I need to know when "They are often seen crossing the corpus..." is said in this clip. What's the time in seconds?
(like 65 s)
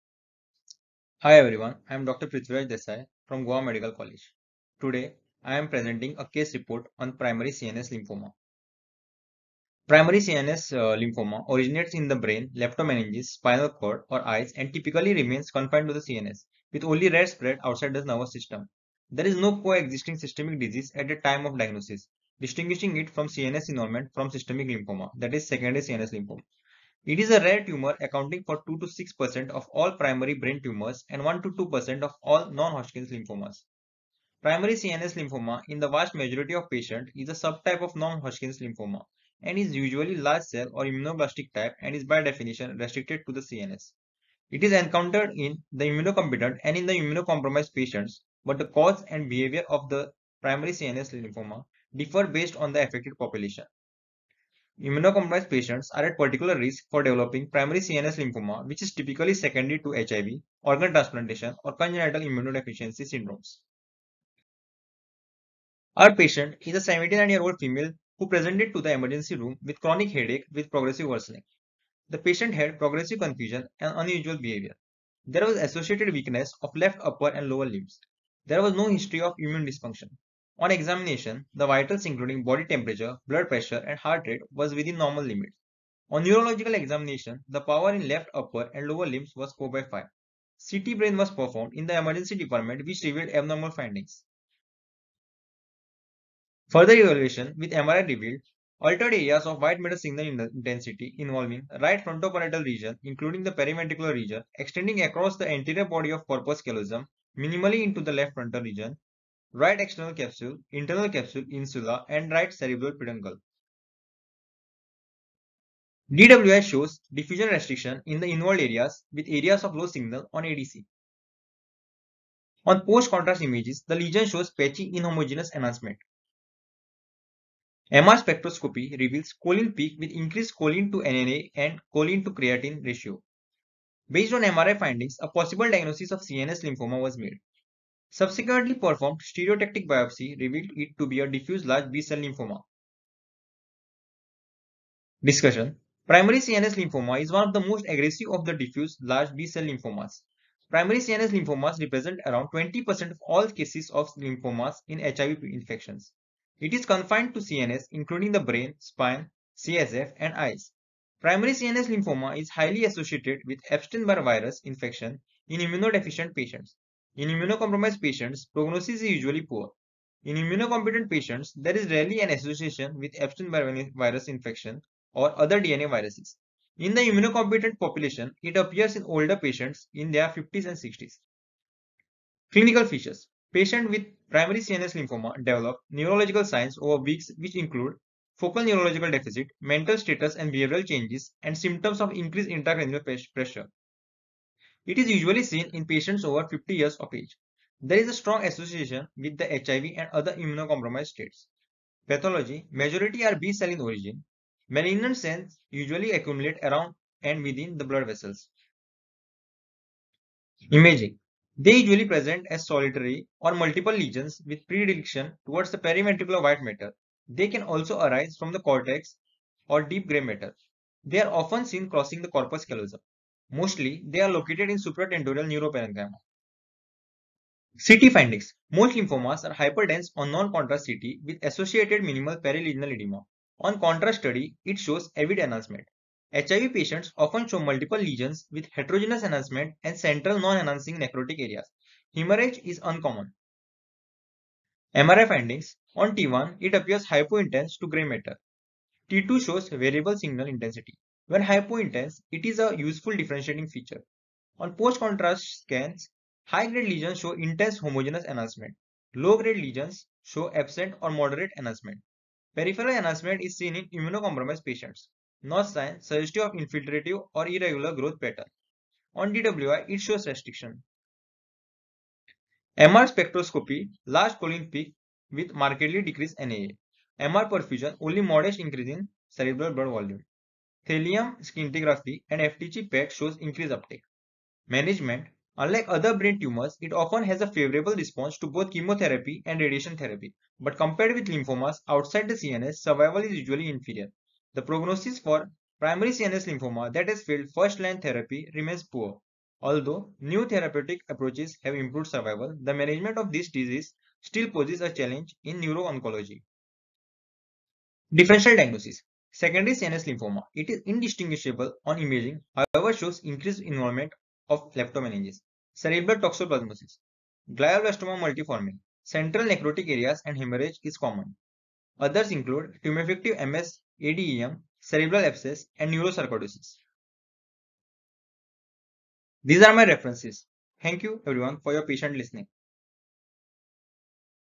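221 s.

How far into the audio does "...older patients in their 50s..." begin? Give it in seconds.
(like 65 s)
179 s.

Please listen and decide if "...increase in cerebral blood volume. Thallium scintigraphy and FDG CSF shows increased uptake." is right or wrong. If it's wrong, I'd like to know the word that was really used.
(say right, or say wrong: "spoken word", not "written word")
wrong: "PET", not "CSF".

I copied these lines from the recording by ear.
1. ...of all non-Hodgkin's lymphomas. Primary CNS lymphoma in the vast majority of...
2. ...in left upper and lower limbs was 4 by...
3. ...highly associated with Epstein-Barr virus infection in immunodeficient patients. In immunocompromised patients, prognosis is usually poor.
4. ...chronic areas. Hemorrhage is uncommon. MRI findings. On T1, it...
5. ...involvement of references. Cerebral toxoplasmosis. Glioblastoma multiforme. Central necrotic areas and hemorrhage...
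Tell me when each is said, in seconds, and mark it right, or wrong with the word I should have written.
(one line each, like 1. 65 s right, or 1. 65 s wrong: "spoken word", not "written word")
1. 32 s right
2. 87 s right
3. 162 s right
4. 240 s wrong: "necrotic", not "chronic"
5. 313 s wrong: "leptomeninges", not "references".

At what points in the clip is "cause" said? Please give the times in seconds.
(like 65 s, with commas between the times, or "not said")
48 s.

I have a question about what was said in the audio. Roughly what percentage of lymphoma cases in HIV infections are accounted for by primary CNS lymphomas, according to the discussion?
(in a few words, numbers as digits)
20%.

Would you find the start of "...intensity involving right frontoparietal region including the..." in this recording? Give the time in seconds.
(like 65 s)
100 s.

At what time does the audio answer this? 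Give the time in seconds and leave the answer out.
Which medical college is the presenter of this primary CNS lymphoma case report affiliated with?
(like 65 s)
3 s.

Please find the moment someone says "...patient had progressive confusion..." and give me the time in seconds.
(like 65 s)
72 s.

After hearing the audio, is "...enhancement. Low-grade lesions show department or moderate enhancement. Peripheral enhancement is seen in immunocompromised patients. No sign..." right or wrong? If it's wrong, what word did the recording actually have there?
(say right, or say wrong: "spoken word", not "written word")
wrong: "absent", not "department".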